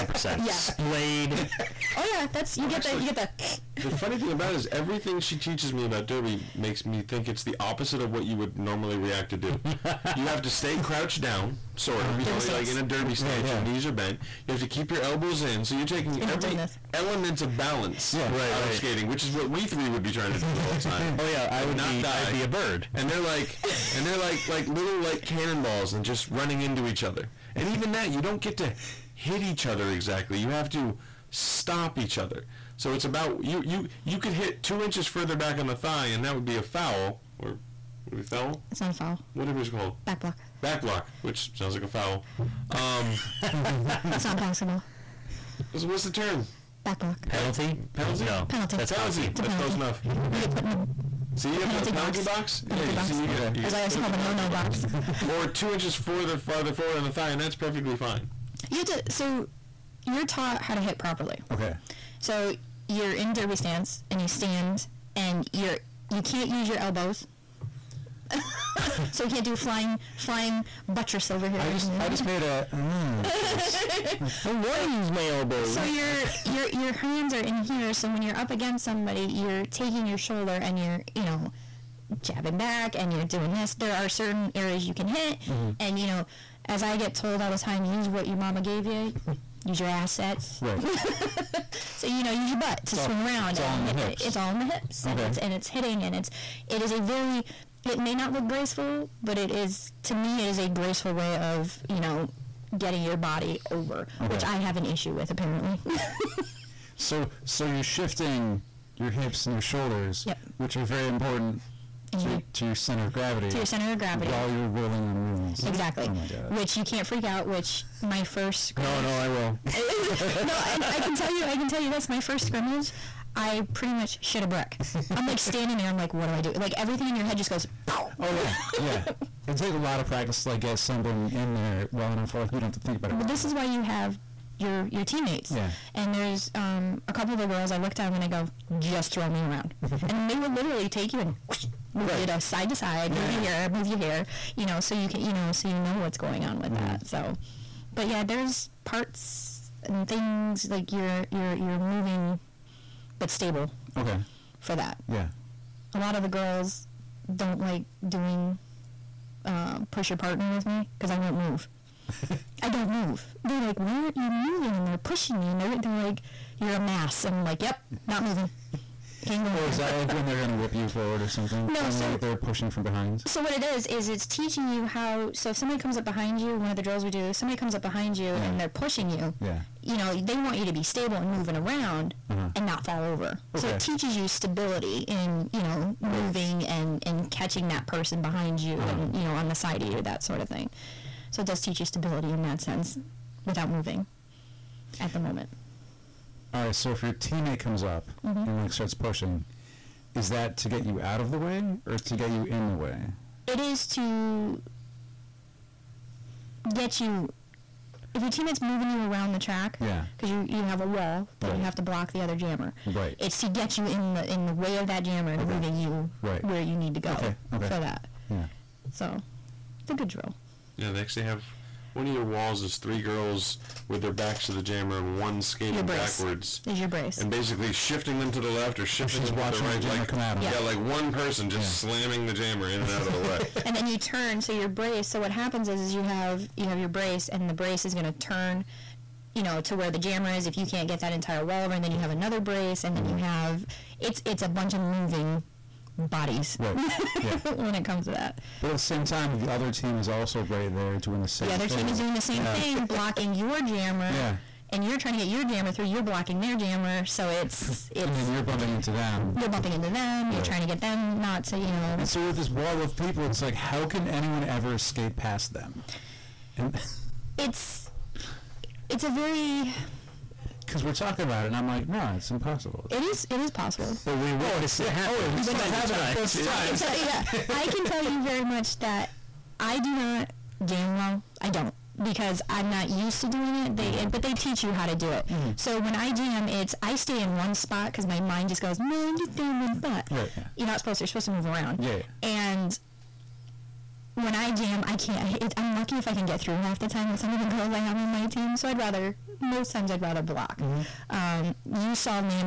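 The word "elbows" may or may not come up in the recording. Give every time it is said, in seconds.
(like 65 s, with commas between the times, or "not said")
15 s, 66 s, 75 s.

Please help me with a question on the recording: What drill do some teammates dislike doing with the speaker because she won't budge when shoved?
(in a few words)
push your partner.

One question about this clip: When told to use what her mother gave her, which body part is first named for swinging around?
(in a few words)
butt.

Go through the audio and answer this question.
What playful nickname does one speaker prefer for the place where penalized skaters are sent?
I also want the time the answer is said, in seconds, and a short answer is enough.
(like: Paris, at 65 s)
the no no box, at 54 s.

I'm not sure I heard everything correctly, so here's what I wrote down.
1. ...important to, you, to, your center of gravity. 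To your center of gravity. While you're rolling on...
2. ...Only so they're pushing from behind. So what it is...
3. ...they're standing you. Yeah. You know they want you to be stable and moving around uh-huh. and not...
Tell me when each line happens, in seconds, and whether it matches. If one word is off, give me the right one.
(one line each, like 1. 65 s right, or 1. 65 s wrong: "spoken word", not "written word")
1. 111 s right
2. 171 s right
3. 178 s wrong: "pushing", not "standing".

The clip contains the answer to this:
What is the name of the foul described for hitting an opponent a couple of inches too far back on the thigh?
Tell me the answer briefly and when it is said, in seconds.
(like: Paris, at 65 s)
Back block, at 40 s.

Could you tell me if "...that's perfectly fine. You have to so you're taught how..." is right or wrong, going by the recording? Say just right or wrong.
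right.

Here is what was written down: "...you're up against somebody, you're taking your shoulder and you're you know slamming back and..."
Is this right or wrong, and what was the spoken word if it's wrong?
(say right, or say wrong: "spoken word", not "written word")
wrong: "jabbing", not "slamming".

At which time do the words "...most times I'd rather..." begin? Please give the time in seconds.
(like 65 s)
299 s.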